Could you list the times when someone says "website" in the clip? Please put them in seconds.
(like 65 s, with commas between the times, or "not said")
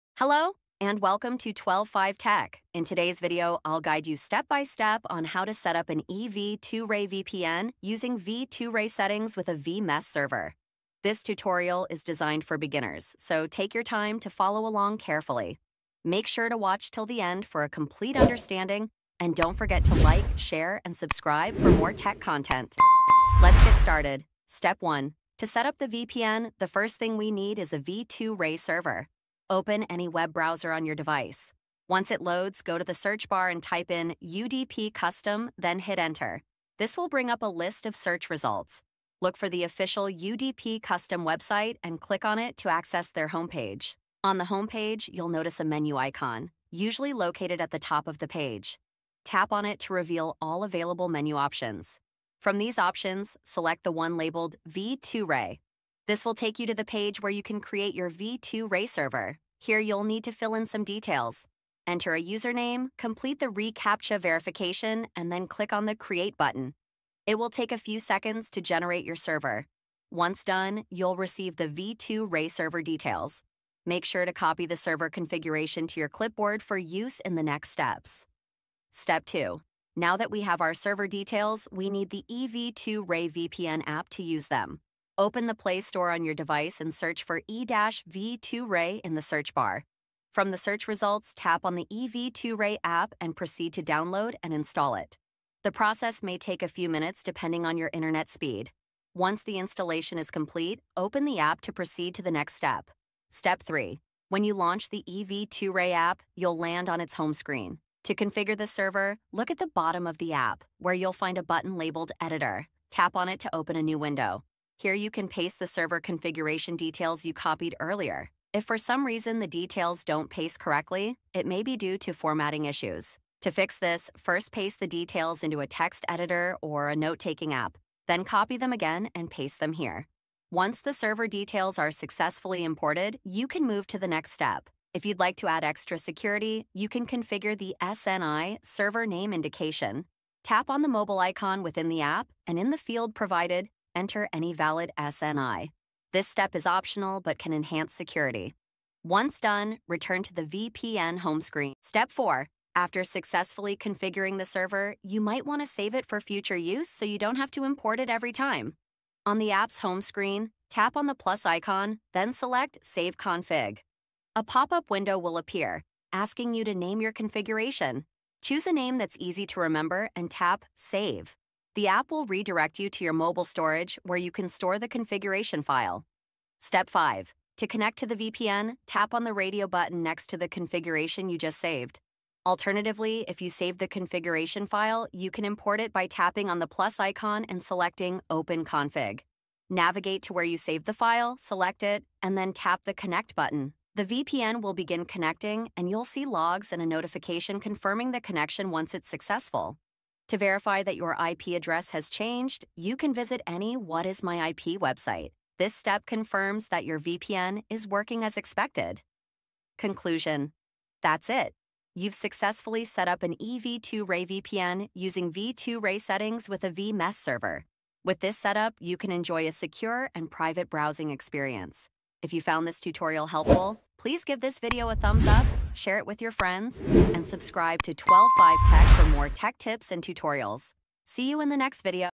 41 s, 204 s.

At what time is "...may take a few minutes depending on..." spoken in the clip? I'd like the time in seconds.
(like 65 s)
96 s.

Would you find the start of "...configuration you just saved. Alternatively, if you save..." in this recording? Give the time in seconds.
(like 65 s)
180 s.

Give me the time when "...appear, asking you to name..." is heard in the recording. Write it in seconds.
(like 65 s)
165 s.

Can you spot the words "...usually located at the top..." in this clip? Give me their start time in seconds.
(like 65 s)
46 s.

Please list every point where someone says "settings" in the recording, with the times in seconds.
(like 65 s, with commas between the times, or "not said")
8 s, 215 s.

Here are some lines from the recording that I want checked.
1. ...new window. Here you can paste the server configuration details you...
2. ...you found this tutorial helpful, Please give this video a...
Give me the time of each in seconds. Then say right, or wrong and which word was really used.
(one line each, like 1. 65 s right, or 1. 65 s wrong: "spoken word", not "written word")
1. 113 s right
2. 222 s right.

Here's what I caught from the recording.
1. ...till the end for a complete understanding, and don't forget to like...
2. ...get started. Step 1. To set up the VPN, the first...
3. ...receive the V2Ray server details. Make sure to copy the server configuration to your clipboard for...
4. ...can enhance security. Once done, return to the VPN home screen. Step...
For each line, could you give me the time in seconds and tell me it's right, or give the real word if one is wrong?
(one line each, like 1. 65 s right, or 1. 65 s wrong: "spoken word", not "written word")
1. 16 s right
2. 23 s right
3. 71 s right
4. 147 s right.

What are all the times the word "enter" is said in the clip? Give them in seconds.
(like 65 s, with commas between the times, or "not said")
35 s, 61 s, 143 s.